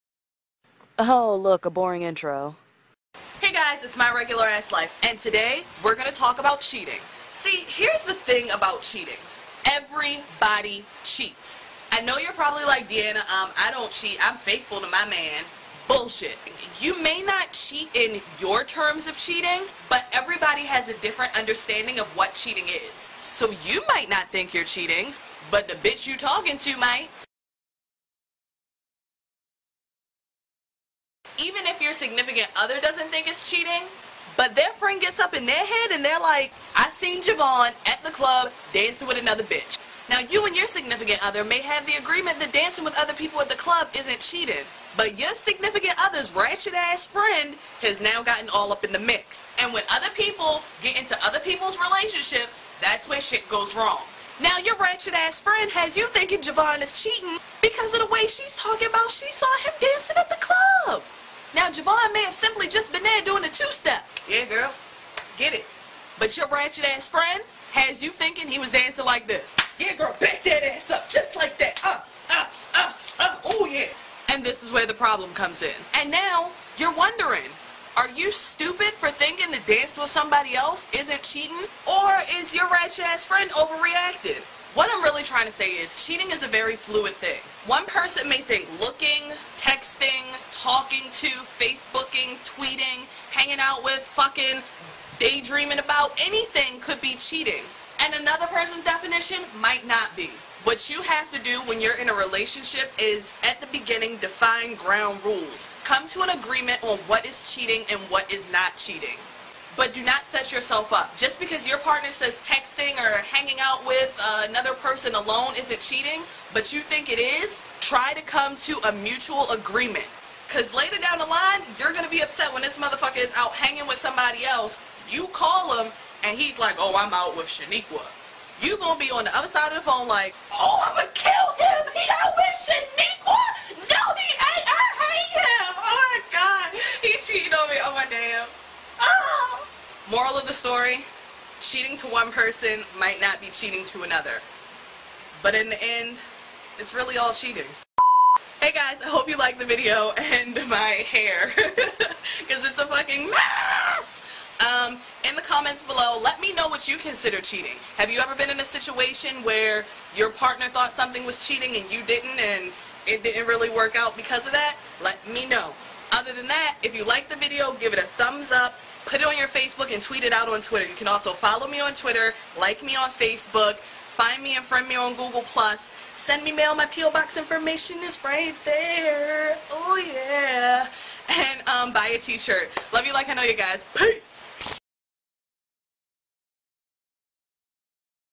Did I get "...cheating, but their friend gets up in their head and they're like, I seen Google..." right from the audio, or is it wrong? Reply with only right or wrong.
wrong.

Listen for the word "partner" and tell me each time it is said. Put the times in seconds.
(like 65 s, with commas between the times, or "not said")
111 s, 160 s.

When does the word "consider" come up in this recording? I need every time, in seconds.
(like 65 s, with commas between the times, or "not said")
156 s.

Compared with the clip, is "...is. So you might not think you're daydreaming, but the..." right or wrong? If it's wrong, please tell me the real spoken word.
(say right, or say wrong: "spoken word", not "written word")
wrong: "cheating", not "daydreaming".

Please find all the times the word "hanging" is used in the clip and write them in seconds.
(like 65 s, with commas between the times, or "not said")
93 s, 113 s, 123 s.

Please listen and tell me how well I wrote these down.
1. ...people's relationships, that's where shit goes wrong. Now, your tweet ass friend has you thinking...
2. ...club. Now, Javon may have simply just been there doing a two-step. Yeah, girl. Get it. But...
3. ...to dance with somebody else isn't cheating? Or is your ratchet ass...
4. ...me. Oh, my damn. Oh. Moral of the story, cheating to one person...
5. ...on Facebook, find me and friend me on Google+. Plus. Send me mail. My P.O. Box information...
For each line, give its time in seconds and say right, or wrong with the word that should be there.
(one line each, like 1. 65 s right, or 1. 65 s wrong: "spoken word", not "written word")
1. 51 s wrong: "ratchet", not "tweet"
2. 60 s right
3. 79 s right
4. 137 s right
5. 172 s right.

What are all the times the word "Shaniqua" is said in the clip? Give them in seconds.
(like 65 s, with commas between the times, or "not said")
127 s, 132 s.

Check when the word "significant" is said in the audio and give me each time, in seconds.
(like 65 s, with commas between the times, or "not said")
32 s, 40 s, 45 s.